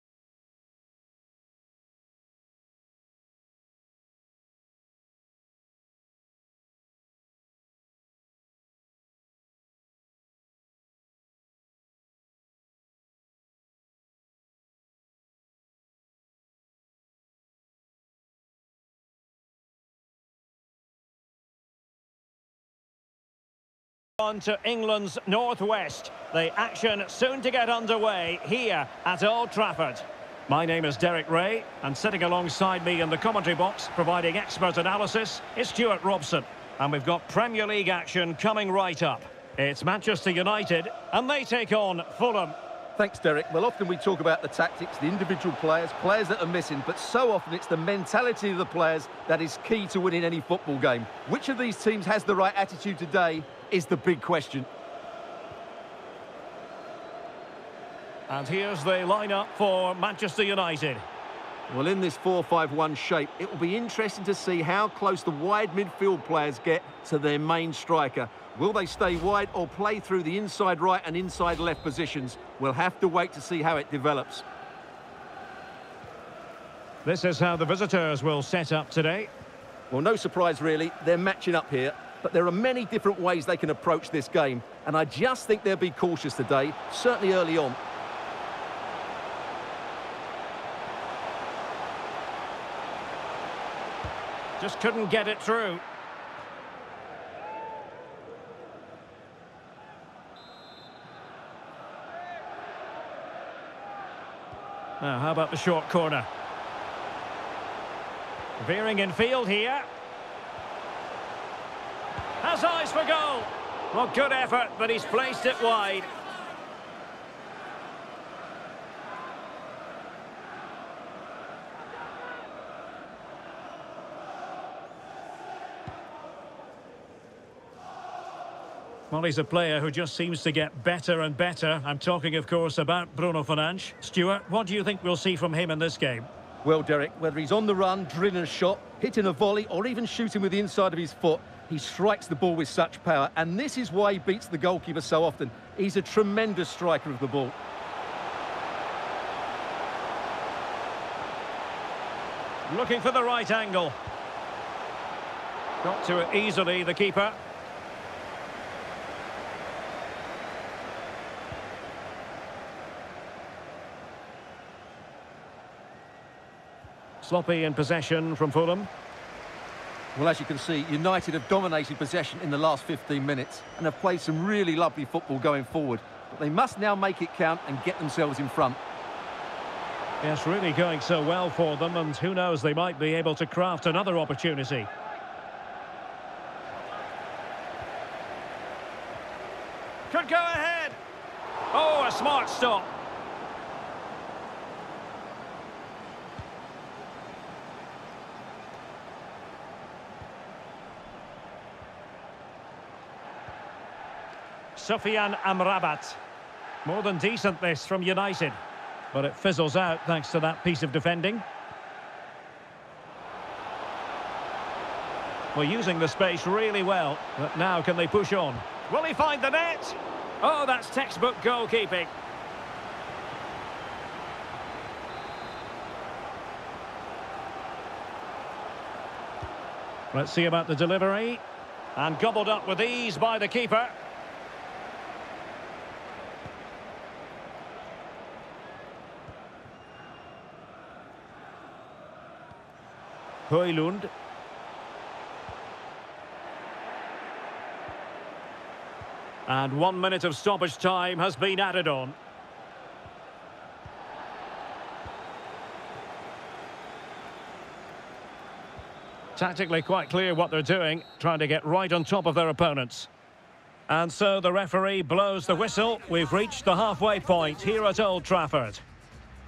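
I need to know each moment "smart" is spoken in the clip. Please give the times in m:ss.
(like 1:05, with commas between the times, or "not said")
3:12.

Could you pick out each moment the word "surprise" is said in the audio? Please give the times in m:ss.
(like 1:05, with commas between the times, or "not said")
1:20.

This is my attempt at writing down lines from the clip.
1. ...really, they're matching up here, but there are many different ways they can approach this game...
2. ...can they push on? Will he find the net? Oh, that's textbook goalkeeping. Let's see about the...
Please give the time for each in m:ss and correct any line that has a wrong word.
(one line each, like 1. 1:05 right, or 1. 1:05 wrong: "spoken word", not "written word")
1. 1:20 right
2. 3:37 right.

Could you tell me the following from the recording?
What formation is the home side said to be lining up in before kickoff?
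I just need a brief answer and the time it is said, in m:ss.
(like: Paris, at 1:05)
4-5-1, at 1:02.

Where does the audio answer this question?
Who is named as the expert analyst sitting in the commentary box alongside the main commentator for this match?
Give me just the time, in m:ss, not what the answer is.
0:35.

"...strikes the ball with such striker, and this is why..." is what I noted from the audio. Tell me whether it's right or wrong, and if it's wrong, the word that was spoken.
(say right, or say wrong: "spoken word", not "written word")
wrong: "power", not "striker".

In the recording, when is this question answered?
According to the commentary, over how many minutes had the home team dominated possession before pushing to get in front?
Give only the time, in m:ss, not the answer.
2:52.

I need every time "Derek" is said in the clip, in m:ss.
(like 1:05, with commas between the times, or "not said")
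0:30, 0:43, 2:16.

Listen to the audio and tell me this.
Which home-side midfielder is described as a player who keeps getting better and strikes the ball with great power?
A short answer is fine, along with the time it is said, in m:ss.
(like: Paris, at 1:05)
Bruno Fernandes, at 2:13.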